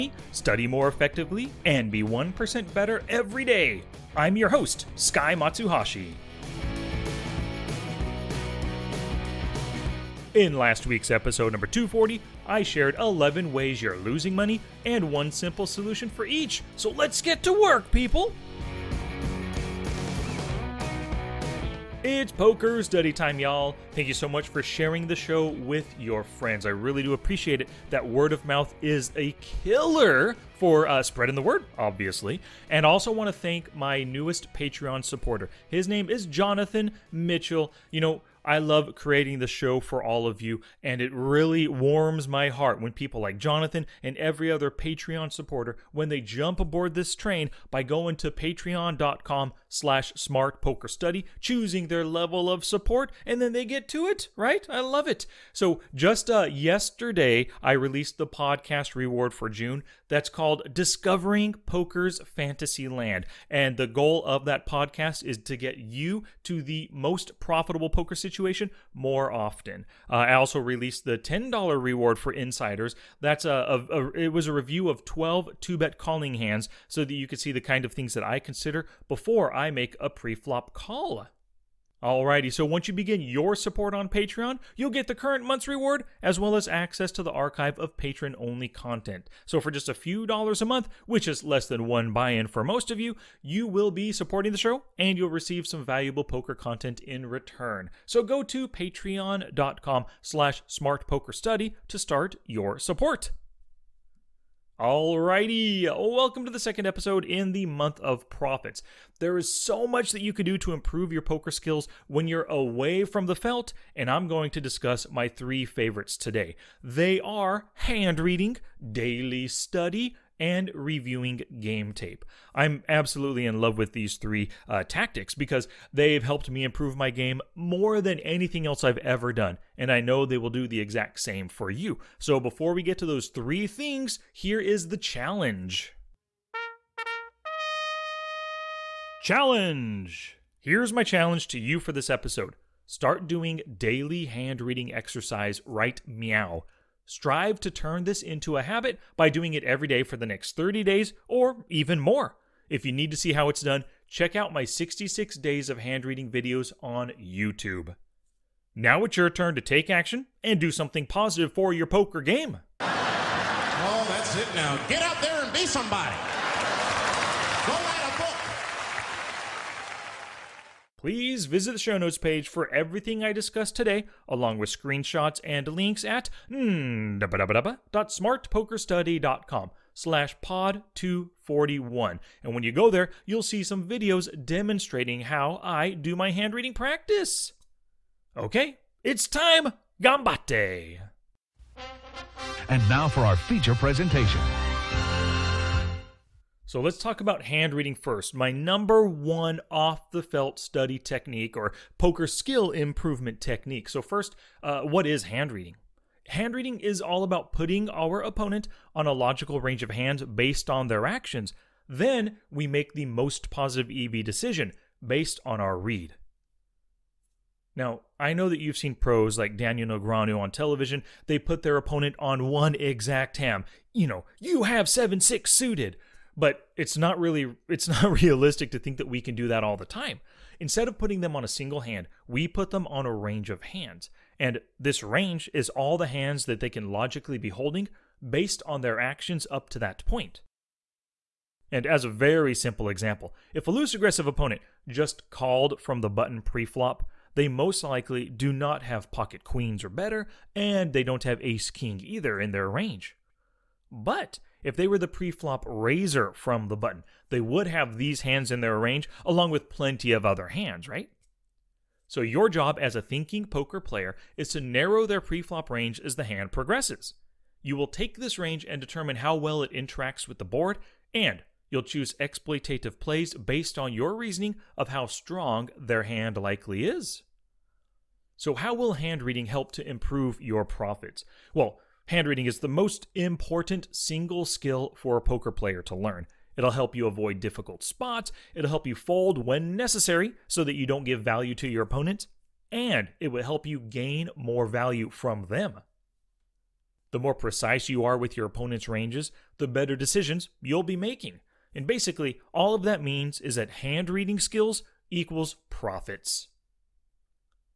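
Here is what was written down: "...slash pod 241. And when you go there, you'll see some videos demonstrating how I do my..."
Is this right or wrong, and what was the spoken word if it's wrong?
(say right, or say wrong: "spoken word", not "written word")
right.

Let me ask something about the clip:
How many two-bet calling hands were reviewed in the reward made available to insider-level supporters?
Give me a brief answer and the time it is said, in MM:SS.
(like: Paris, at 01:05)
12, at 01:15.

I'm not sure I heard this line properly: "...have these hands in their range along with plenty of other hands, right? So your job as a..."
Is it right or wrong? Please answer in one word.
right.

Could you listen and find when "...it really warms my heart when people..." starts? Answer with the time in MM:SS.
00:41.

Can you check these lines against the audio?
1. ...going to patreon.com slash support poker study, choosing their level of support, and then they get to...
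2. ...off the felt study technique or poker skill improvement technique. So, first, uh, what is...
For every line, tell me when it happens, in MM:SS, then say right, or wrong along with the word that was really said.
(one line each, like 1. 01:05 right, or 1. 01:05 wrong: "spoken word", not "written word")
1. 00:47 wrong: "smart", not "support"
2. 03:19 right.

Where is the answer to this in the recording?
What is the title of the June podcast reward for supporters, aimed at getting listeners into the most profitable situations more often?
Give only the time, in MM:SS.
01:00.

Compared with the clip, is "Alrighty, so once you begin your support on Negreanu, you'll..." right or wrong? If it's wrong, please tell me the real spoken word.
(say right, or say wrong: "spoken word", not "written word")
wrong: "Patreon", not "Negreanu".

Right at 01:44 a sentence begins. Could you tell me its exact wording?
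Alrighty, welcome to the second episode in the month of profits.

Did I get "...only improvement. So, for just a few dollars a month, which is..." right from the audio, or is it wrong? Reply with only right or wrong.
wrong.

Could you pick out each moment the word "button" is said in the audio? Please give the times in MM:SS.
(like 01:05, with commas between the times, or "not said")
04:06, 04:16.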